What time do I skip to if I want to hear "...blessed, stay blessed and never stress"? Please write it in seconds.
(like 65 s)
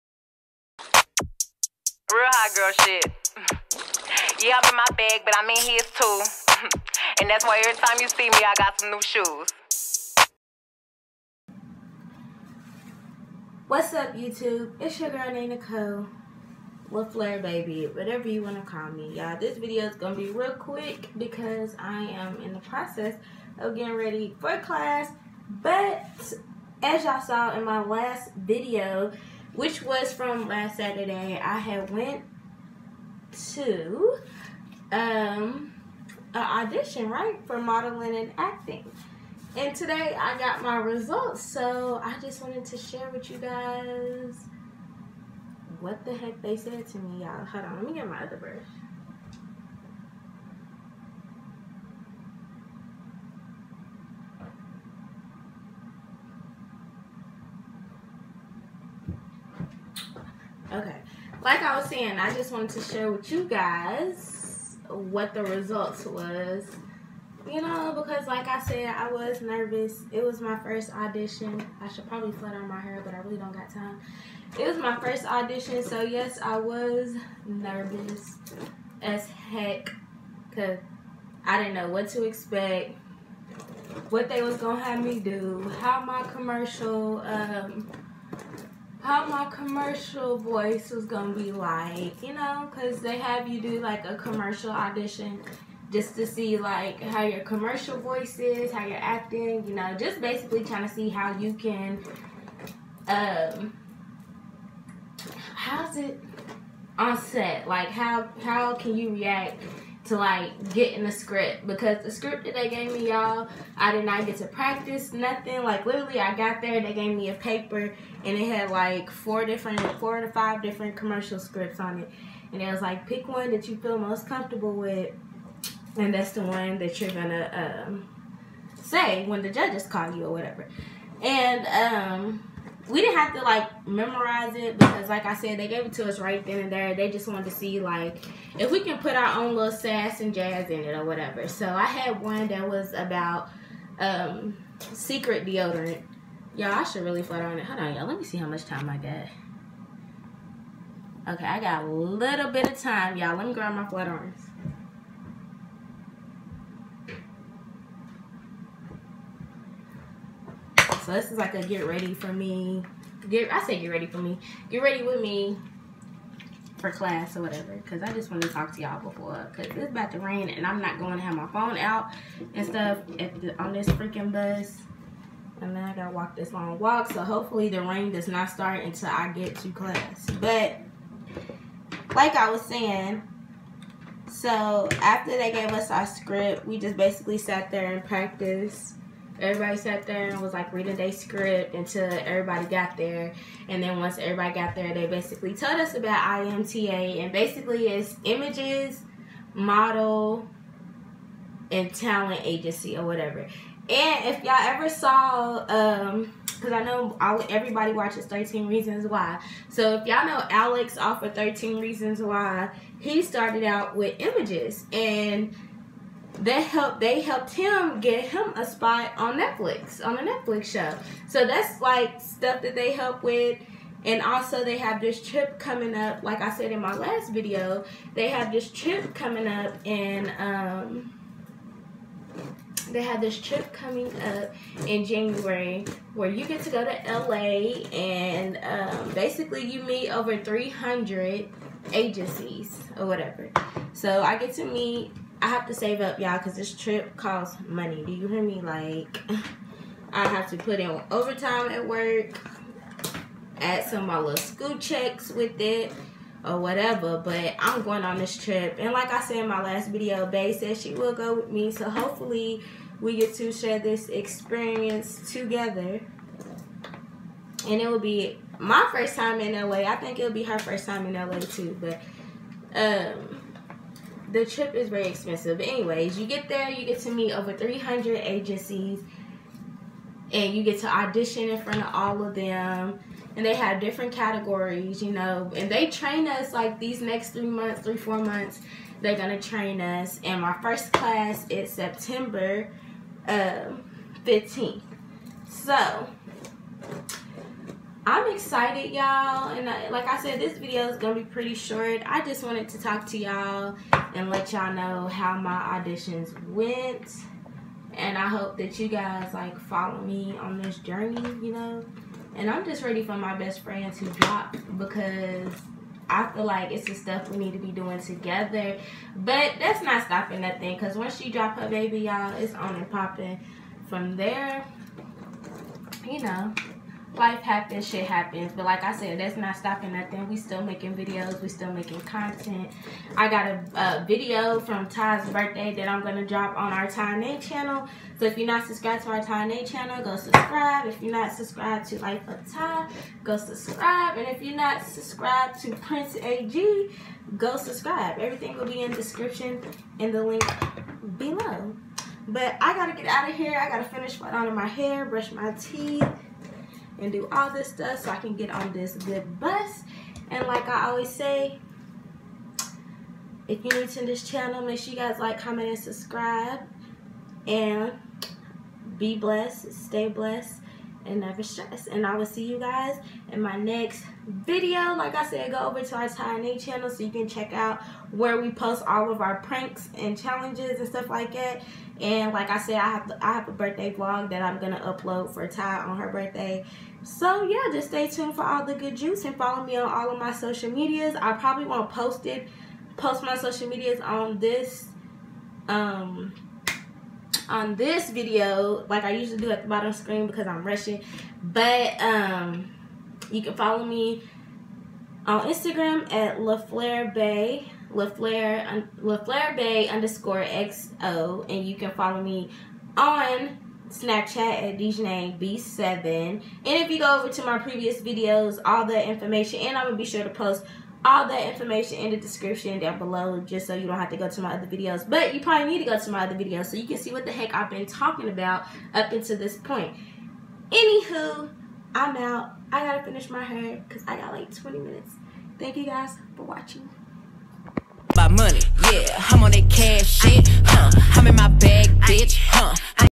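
369 s.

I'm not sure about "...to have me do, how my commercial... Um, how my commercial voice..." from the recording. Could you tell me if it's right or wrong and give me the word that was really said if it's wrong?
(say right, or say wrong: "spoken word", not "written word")
right.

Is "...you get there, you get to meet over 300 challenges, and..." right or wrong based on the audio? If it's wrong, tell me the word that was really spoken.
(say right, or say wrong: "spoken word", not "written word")
wrong: "agencies", not "challenges".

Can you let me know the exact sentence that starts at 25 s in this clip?
But as y'all saw in my last video, which was from last Saturday.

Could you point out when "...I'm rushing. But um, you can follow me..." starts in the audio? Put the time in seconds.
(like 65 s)
400 s.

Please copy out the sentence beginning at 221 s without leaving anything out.
So that's like stuff that they help with.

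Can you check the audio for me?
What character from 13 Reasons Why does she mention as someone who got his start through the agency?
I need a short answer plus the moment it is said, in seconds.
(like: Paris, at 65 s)
Alex, at 210 s.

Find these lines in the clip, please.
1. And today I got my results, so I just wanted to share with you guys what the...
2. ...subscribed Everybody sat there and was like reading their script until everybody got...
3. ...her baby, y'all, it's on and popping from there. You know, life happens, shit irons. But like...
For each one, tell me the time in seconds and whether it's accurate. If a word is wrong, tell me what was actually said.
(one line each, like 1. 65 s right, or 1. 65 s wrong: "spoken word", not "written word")
1. 39 s right
2. 188 s wrong: "practiced", not "subscribed"
3. 321 s wrong: "happens", not "irons".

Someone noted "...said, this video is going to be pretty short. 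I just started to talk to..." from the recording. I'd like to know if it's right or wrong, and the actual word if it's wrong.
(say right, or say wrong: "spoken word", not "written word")
wrong: "wanted", not "started".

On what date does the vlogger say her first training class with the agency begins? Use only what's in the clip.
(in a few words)
September 15th.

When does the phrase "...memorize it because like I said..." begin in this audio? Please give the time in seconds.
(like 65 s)
133 s.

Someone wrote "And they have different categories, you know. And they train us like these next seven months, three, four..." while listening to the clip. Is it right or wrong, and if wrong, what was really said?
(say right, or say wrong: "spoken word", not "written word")
wrong: "three", not "seven".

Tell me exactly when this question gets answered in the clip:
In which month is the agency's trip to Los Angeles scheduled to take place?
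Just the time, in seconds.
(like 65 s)
235 s.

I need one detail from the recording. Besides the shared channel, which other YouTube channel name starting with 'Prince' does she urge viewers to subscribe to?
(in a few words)
Prince AG.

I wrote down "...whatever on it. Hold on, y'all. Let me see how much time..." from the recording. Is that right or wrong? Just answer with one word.
wrong.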